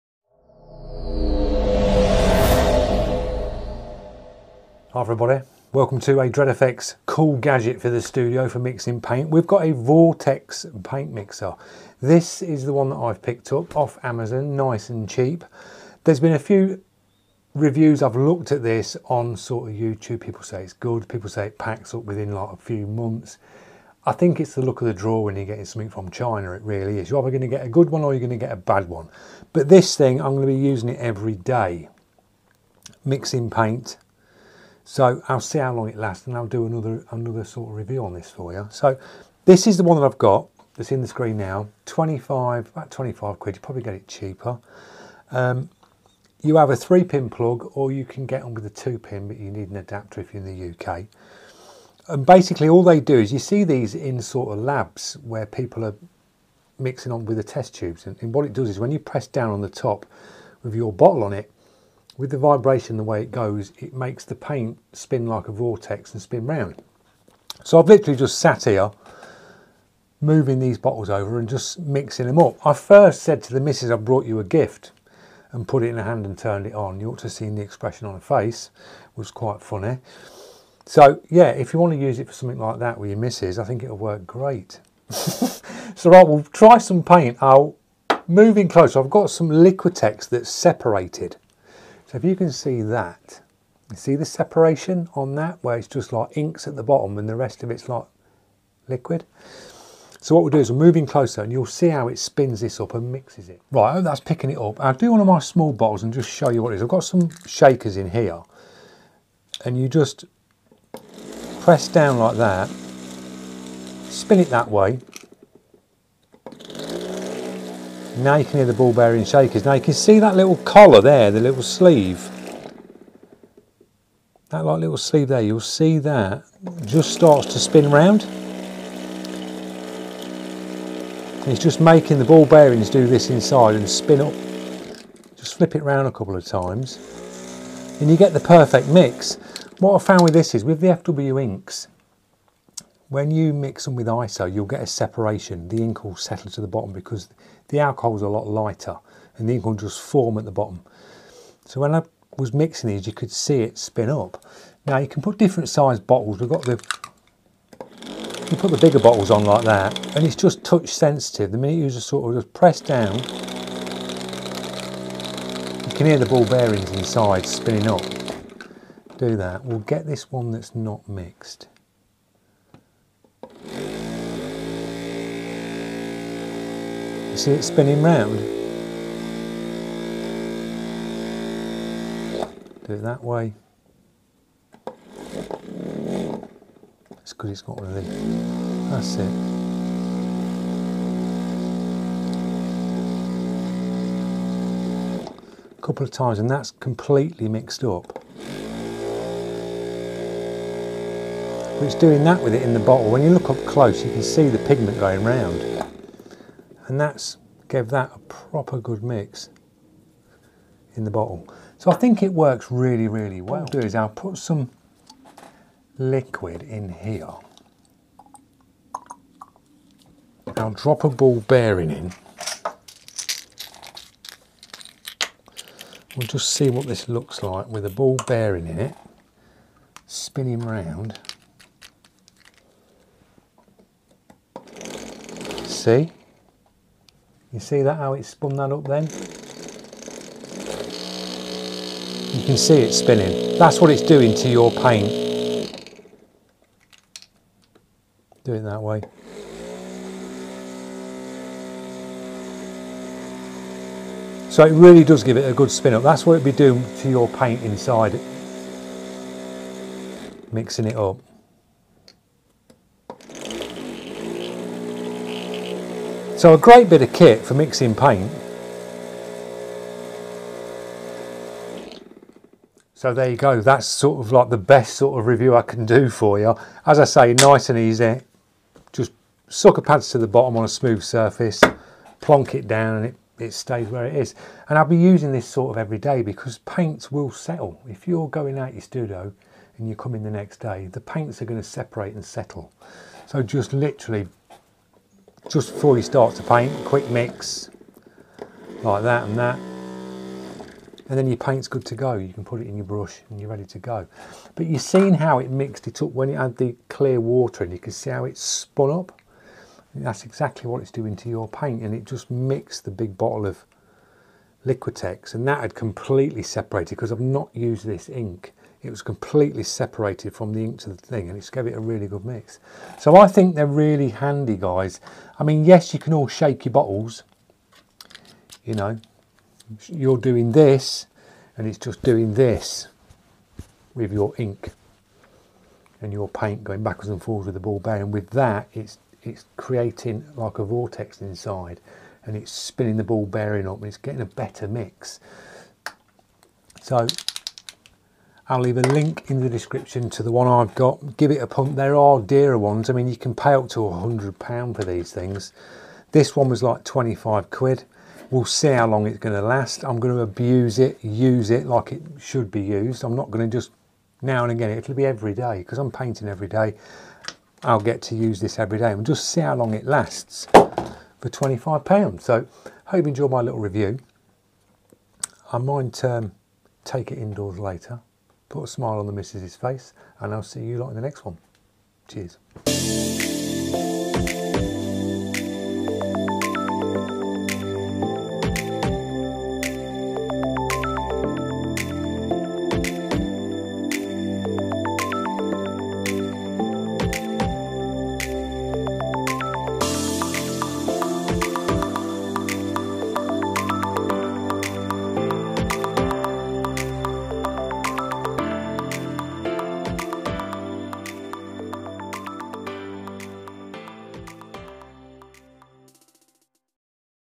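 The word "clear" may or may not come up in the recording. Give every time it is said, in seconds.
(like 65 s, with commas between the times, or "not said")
306 s.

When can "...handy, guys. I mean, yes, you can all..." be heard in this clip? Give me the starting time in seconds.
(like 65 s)
324 s.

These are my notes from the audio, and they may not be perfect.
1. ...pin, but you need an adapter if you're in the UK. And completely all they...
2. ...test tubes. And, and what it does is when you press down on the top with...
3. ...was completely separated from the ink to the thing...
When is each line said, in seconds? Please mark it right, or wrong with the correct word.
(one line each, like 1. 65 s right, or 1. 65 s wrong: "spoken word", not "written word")
1. 48 s wrong: "basically", not "completely"
2. 57 s right
3. 318 s right.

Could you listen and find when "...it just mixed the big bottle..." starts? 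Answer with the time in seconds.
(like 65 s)
311 s.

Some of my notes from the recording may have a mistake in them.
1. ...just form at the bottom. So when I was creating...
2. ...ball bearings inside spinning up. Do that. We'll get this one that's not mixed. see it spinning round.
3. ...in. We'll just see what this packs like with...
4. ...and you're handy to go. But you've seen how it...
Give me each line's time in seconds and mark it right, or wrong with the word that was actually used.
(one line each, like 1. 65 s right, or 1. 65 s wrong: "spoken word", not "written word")
1. 149 s wrong: "mixing", not "creating"
2. 166 s right
3. 221 s wrong: "looks", not "packs"
4. 303 s wrong: "ready", not "handy".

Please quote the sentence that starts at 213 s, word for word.
What I'll do is I'll put some liquid in here.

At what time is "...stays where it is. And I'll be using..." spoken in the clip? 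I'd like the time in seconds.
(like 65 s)
283 s.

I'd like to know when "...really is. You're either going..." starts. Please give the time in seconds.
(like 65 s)
26 s.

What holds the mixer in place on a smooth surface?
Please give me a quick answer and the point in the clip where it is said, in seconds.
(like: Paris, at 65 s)
Sucker pads, at 279 s.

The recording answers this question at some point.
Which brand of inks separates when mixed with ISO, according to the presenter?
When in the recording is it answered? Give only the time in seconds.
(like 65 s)
140 s.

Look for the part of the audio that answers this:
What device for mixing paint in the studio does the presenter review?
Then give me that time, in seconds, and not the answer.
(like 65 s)
9 s.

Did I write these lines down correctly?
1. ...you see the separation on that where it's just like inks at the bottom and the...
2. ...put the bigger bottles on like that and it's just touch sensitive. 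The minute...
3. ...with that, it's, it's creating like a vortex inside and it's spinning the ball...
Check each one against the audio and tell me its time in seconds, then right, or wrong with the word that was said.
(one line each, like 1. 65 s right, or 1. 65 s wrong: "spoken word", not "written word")
1. 93 s right
2. 158 s right
3. 338 s right.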